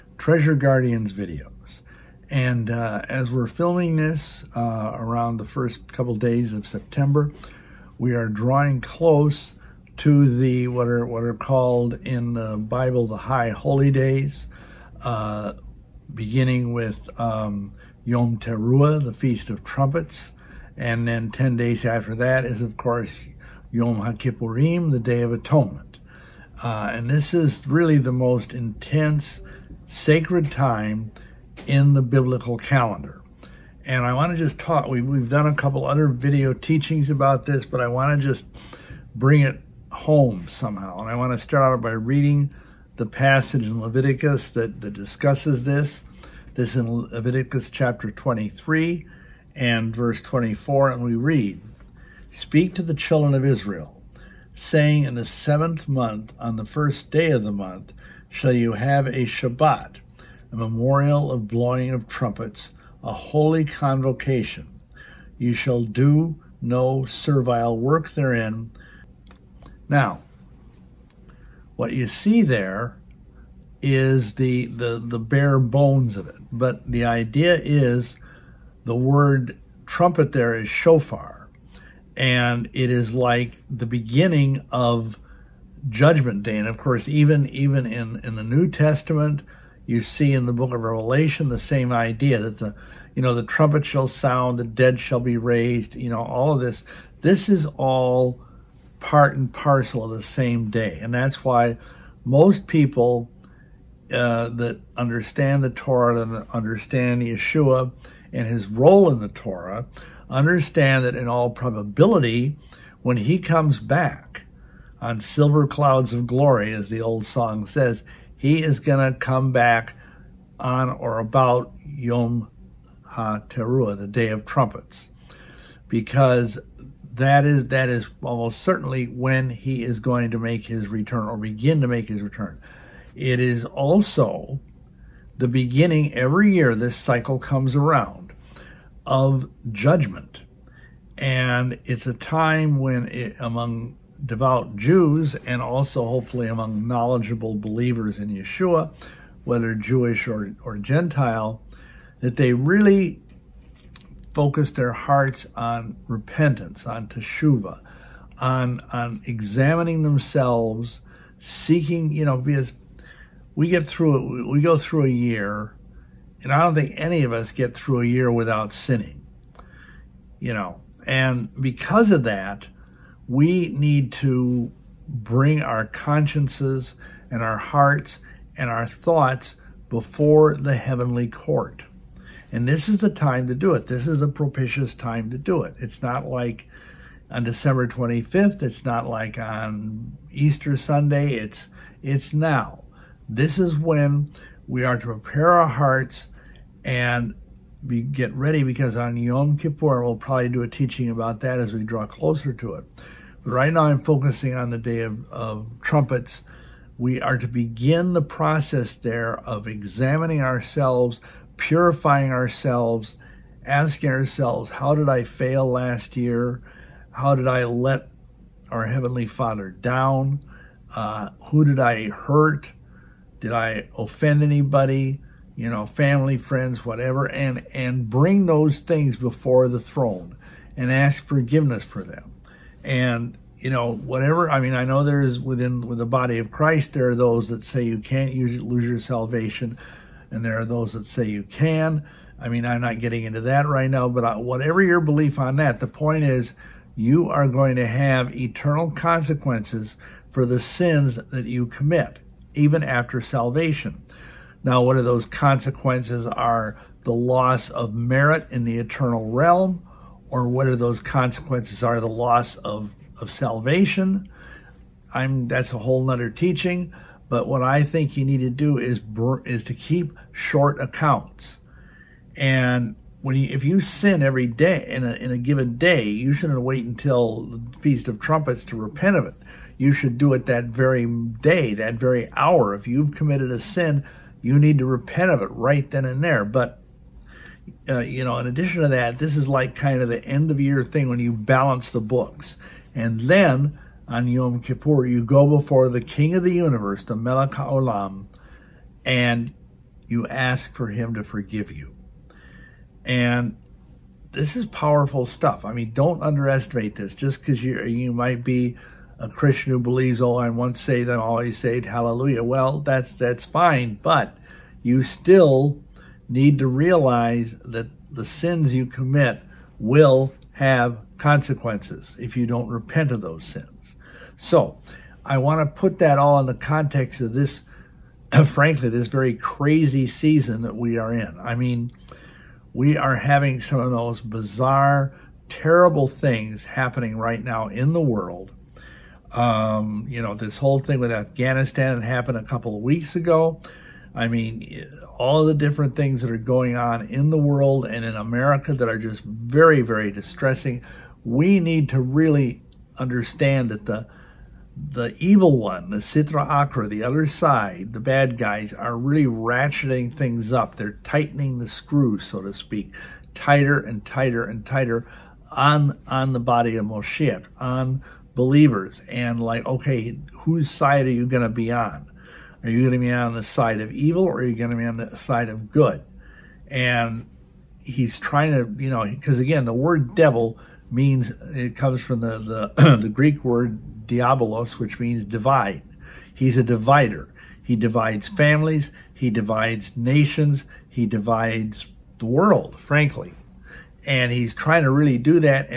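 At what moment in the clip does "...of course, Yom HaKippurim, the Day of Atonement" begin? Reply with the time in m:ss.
0:22.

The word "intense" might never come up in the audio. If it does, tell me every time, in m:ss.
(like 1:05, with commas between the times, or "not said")
0:28.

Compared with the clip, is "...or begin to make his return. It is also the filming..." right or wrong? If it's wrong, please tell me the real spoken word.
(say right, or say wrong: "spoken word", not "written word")
wrong: "beginning", not "filming".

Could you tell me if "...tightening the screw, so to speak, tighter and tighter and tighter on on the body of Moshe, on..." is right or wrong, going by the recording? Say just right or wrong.
right.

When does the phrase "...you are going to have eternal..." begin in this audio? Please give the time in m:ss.
4:06.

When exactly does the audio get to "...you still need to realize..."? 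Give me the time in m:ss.
5:14.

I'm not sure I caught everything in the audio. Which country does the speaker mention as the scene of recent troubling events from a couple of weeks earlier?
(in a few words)
Afghanistan.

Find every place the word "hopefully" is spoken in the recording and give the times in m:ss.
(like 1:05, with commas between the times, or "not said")
2:26.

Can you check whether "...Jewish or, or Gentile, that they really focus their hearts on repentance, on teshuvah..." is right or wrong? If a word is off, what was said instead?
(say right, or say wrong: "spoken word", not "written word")
right.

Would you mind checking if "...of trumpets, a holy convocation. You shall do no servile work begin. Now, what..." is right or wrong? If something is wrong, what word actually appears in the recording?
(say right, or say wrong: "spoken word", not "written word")
wrong: "therein", not "begin".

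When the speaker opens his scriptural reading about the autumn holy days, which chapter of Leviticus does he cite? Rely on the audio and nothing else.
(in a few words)
Chapter 23.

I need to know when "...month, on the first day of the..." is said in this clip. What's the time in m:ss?
0:55.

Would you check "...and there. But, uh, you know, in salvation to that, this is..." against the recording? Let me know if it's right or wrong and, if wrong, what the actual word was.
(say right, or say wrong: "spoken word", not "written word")
wrong: "addition", not "salvation".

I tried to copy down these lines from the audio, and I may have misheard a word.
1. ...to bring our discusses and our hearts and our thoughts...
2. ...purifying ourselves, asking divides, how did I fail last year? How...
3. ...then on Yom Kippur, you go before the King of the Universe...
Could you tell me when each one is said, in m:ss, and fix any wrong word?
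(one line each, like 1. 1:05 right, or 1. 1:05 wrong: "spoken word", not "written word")
1. 2:54 wrong: "consciences", not "discusses"
2. 3:31 wrong: "ourselves", not "divides"
3. 4:53 right.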